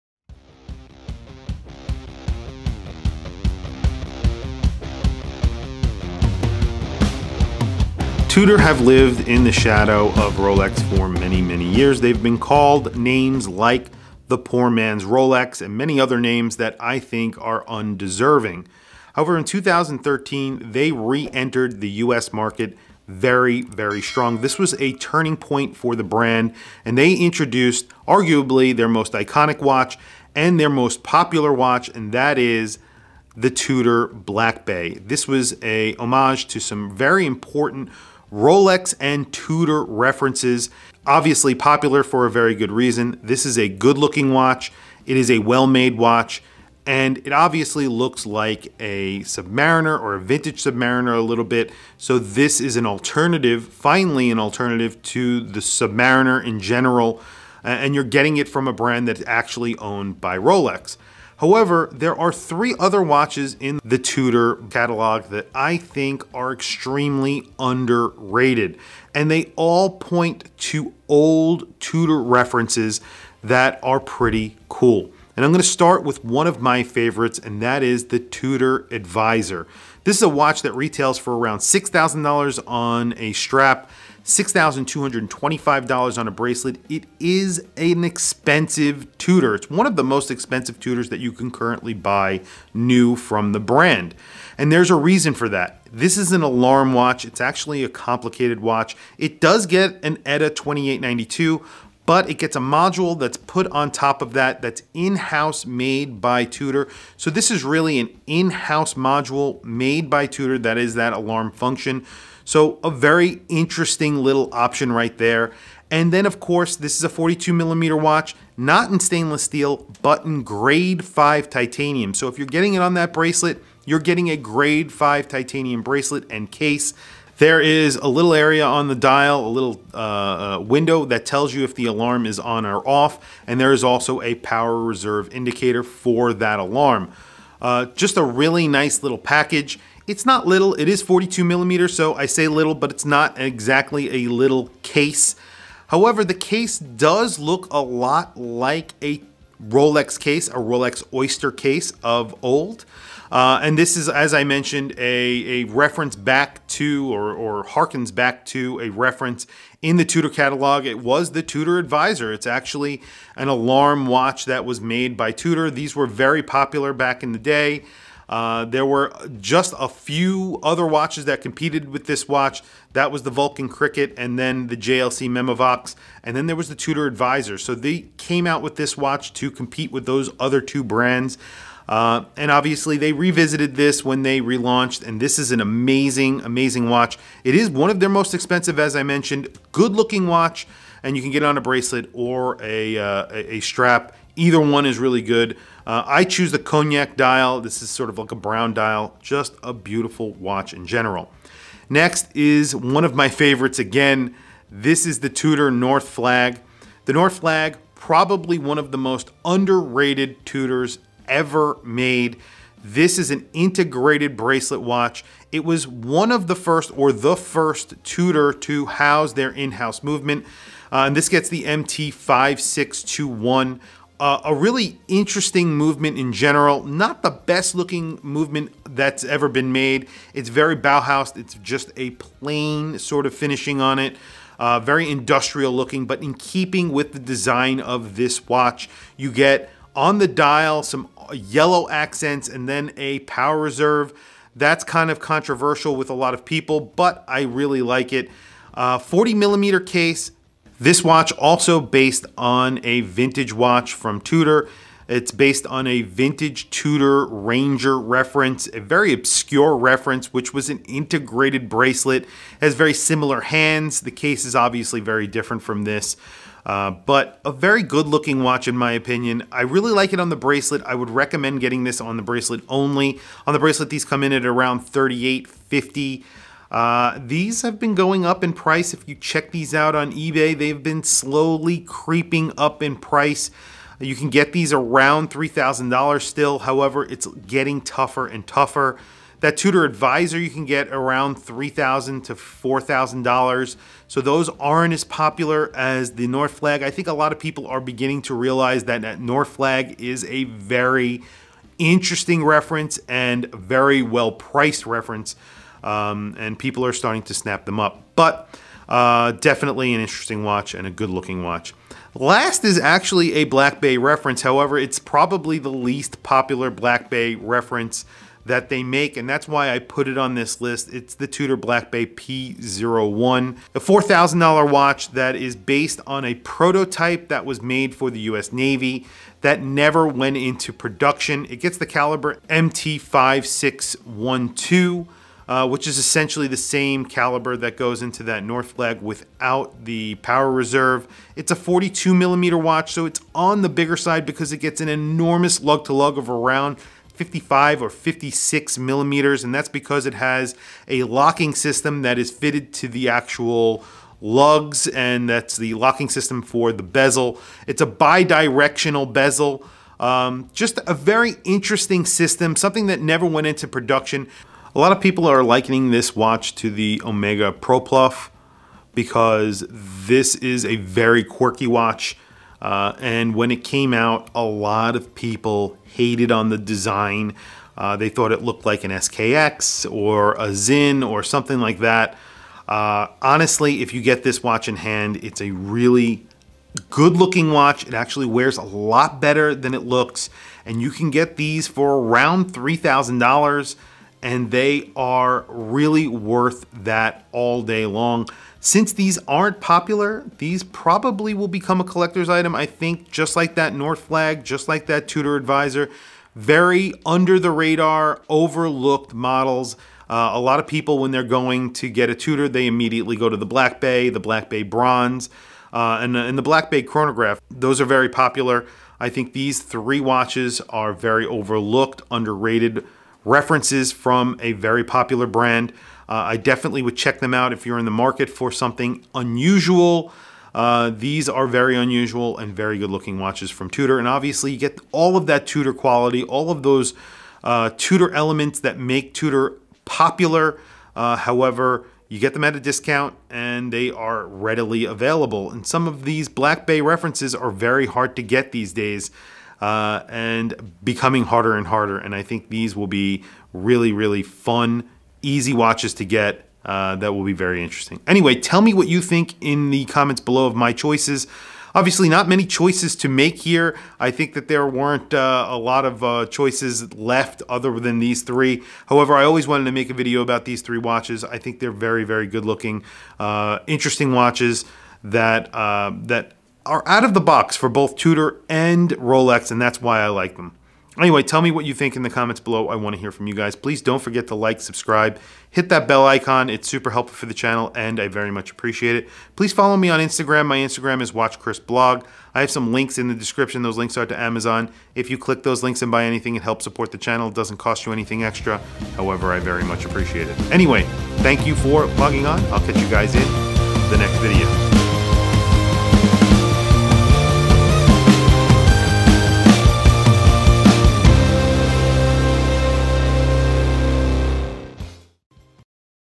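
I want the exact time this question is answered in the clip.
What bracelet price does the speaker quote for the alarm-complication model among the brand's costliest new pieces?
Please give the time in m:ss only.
1:24.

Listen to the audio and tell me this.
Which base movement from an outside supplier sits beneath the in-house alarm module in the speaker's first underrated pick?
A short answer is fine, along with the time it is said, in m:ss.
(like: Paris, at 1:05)
ETA 2892, at 1:40.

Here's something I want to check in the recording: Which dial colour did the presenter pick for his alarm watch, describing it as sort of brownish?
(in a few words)
Cognac.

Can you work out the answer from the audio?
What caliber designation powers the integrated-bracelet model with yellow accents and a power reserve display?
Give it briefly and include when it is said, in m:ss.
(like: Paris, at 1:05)
MT5621, at 3:41.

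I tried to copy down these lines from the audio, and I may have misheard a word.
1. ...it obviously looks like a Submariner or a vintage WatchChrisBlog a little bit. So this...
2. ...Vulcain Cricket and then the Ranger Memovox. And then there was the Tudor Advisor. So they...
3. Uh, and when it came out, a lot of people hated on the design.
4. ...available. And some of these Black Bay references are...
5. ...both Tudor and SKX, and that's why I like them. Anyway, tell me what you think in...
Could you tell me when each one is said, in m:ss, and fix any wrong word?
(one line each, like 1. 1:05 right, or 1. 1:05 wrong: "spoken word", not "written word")
1. 0:47 wrong: "Submariner", not "WatchChrisBlog"
2. 2:53 wrong: "JLC", not "Ranger"
3. 6:12 right
4. 7:24 right
5. 7:57 wrong: "Rolex", not "SKX".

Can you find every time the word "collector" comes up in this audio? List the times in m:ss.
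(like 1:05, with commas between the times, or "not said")
6:41.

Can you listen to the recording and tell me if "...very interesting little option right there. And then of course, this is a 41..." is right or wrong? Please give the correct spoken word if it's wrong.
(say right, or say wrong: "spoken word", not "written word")
wrong: "42", not "41".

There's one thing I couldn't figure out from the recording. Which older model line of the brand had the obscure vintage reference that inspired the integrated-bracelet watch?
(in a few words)
Tudor Ranger.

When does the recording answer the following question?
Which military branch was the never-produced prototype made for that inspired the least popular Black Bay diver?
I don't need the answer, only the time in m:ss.
5:28.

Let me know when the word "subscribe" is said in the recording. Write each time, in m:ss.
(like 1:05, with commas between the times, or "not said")
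8:04.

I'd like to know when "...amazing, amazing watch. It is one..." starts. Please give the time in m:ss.
3:05.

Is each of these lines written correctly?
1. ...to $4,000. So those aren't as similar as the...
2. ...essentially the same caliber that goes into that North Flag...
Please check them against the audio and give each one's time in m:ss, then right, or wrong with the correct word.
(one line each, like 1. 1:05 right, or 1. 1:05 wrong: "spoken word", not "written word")
1. 4:52 wrong: "popular", not "similar"
2. 5:35 right.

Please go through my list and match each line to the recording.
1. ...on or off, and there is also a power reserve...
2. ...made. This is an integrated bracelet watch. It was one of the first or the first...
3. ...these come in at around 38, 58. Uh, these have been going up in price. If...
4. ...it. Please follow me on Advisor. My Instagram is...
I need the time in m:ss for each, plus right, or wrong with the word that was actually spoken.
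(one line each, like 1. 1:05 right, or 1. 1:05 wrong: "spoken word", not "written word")
1. 2:12 right
2. 3:31 right
3. 4:33 wrong: "50", not "58"
4. 8:08 wrong: "Instagram", not "Advisor".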